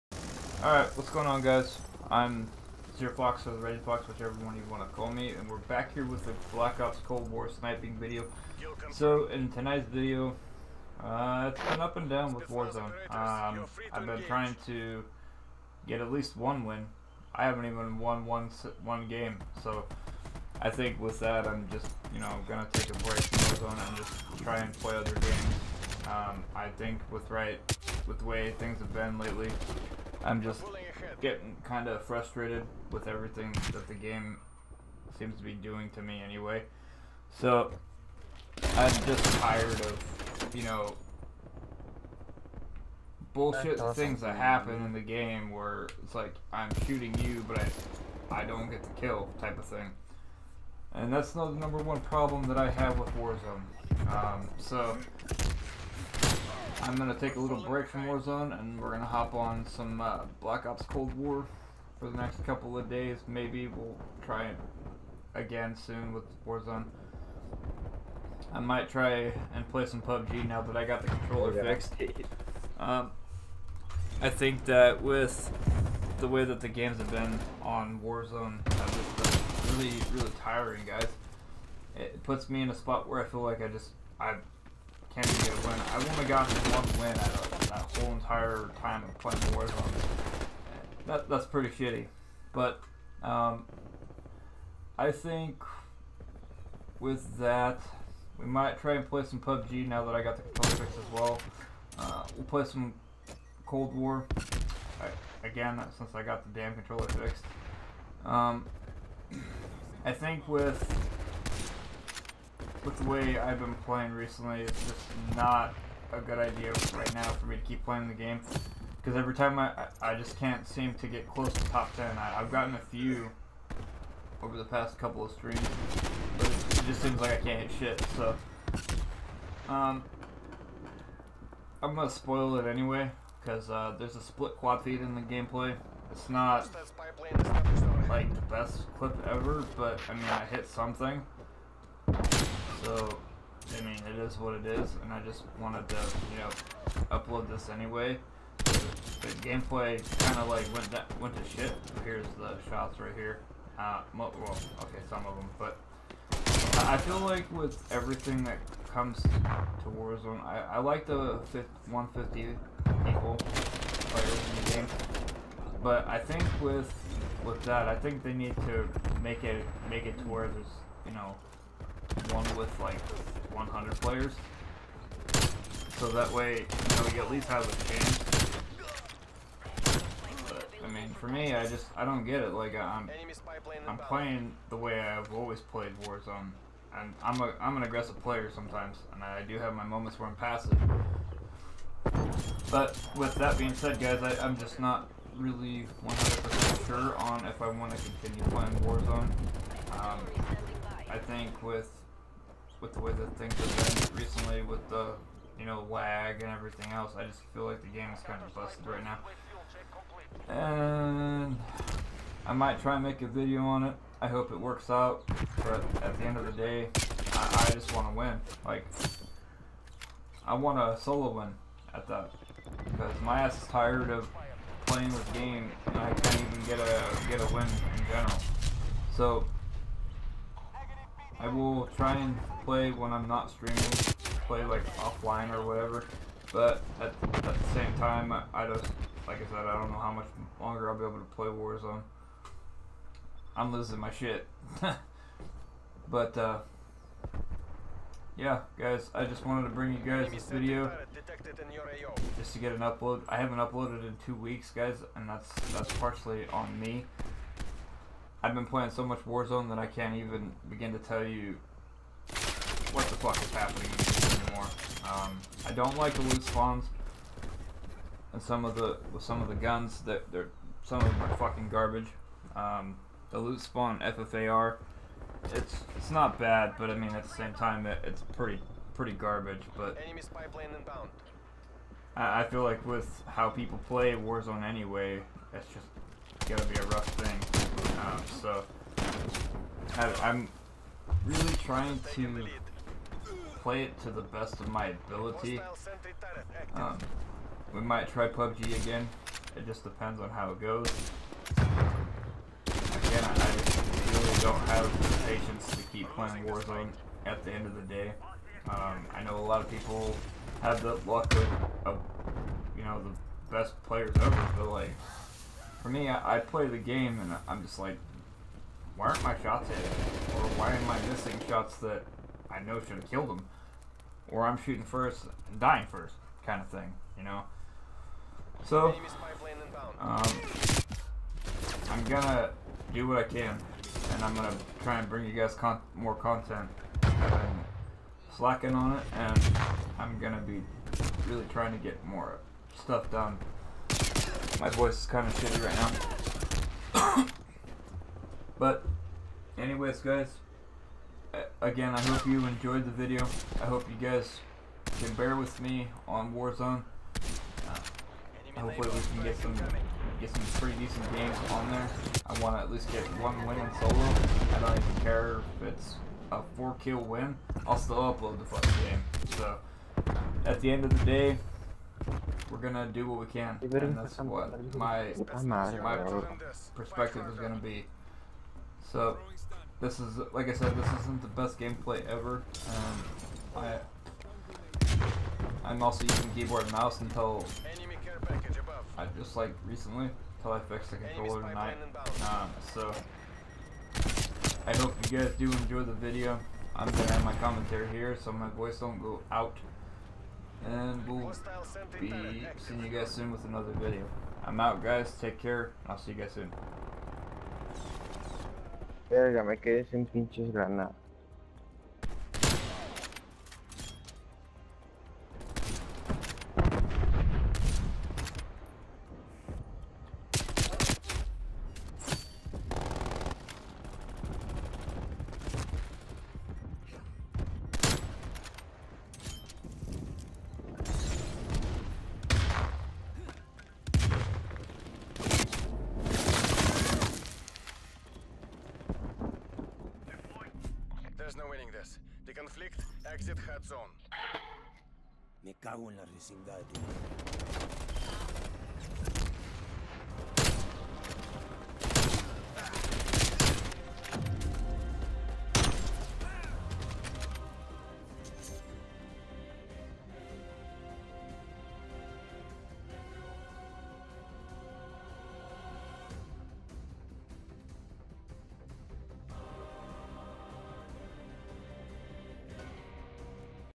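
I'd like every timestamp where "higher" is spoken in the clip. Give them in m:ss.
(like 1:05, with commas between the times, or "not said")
not said.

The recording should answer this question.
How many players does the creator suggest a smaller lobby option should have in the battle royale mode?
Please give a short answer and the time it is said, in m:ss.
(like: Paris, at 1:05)
100, at 2:53.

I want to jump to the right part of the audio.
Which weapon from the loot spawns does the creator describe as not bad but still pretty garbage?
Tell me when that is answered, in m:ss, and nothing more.
4:33.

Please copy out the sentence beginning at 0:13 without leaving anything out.
Um, I've been trying to get at least one win.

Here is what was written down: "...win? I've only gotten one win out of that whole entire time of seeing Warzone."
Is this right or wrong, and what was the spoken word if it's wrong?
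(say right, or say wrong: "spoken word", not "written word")
wrong: "playing", not "seeing".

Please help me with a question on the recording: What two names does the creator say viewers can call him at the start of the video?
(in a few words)
Zero Fox or the Red Fox.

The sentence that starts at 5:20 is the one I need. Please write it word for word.
Or why am I missing shots that I know should have killed them?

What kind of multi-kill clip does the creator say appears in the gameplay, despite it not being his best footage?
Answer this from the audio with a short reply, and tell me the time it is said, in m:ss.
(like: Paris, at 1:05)
split quad feed, at 2:14.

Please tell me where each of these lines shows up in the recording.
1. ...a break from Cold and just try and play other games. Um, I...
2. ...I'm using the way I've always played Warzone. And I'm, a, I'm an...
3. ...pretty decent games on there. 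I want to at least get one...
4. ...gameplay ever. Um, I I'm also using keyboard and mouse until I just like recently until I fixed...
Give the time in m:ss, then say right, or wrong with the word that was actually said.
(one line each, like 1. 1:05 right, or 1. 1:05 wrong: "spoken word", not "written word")
1. 0:22 wrong: "Warzone", not "Cold"
2. 3:03 wrong: "playing", not "using"
3. 6:00 right
4. 6:21 right.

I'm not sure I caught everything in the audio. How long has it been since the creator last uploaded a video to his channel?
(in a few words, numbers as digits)
two weeks.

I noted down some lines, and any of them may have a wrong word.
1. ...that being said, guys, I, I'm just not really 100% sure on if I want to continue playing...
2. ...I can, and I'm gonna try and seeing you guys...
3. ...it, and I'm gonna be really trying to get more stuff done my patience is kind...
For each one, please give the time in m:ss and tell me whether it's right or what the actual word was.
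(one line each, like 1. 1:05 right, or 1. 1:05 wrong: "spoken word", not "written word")
1. 3:13 right
2. 5:33 wrong: "bring", not "seeing"
3. 5:38 wrong: "voice", not "patience".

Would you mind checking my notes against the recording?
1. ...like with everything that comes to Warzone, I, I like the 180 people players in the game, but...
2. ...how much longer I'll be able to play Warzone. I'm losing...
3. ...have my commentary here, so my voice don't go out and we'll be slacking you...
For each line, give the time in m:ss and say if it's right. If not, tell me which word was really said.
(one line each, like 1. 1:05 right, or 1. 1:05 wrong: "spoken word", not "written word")
1. 2:37 wrong: "150", not "180"
2. 3:59 right
3. 6:37 wrong: "seeing", not "slacking".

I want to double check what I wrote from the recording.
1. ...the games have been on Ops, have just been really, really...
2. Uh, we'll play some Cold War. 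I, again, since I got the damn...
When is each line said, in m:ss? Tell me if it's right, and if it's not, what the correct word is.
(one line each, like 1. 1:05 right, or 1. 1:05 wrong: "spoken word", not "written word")
1. 1:16 wrong: "Warzone", not "Ops"
2. 1:41 right.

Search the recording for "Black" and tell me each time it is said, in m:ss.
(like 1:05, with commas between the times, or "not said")
0:06, 1:00.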